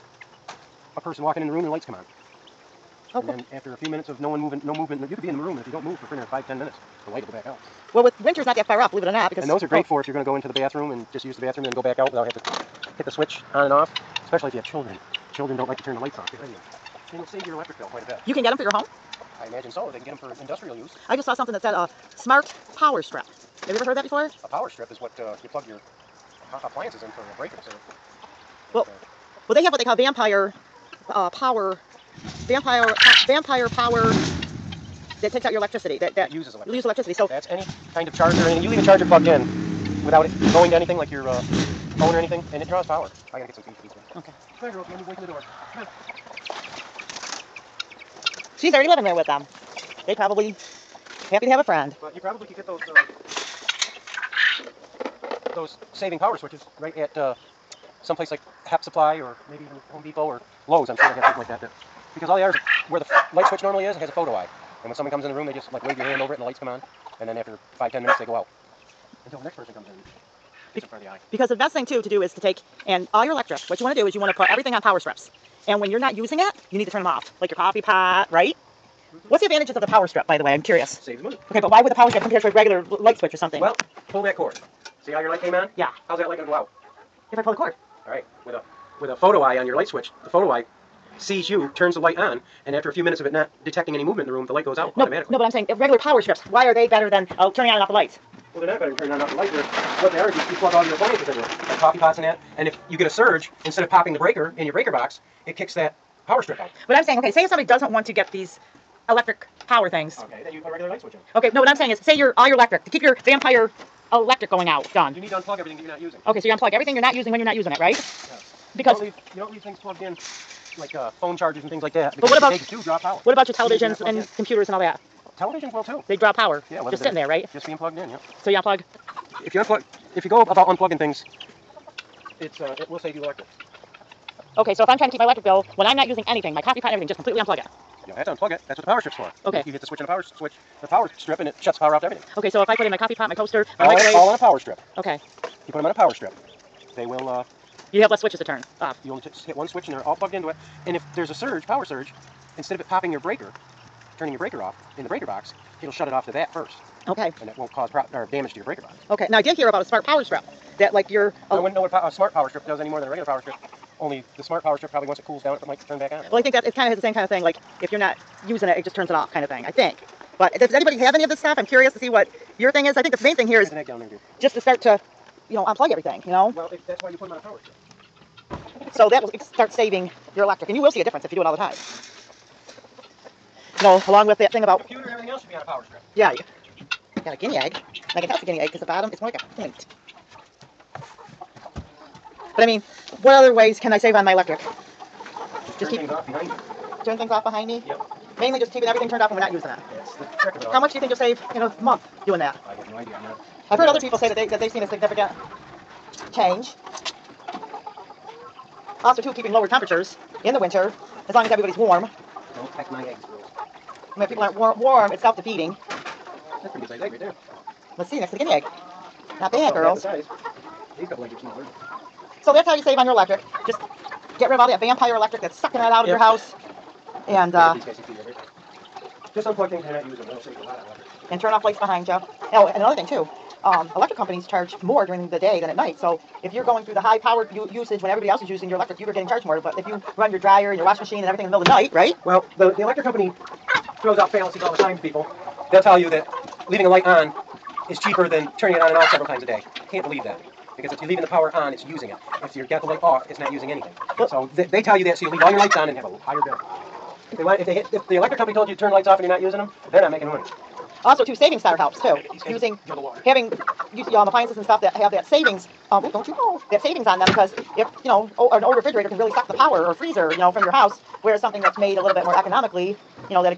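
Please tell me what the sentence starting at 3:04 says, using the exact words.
computer and everything else should be on a power strip.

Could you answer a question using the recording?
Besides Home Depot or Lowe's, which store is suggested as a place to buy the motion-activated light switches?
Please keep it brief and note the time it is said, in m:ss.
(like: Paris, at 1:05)
Hep Supply, at 0:58.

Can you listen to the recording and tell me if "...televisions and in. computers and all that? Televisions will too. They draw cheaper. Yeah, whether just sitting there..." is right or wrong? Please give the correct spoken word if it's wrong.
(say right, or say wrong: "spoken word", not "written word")
wrong: "power", not "cheaper".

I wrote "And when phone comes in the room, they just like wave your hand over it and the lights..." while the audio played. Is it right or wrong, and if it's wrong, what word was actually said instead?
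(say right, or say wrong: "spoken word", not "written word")
wrong: "someone", not "phone".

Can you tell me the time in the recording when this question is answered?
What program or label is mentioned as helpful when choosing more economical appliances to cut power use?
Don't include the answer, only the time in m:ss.
4:21.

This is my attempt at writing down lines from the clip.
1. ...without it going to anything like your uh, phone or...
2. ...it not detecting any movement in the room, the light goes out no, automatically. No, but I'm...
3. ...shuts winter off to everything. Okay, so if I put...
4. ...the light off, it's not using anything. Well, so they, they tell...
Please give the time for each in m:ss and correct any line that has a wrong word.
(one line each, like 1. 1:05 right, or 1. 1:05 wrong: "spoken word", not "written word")
1. 0:40 right
2. 1:33 right
3. 2:21 wrong: "power", not "winter"
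4. 4:12 right.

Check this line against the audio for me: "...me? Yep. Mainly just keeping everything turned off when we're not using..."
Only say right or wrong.
right.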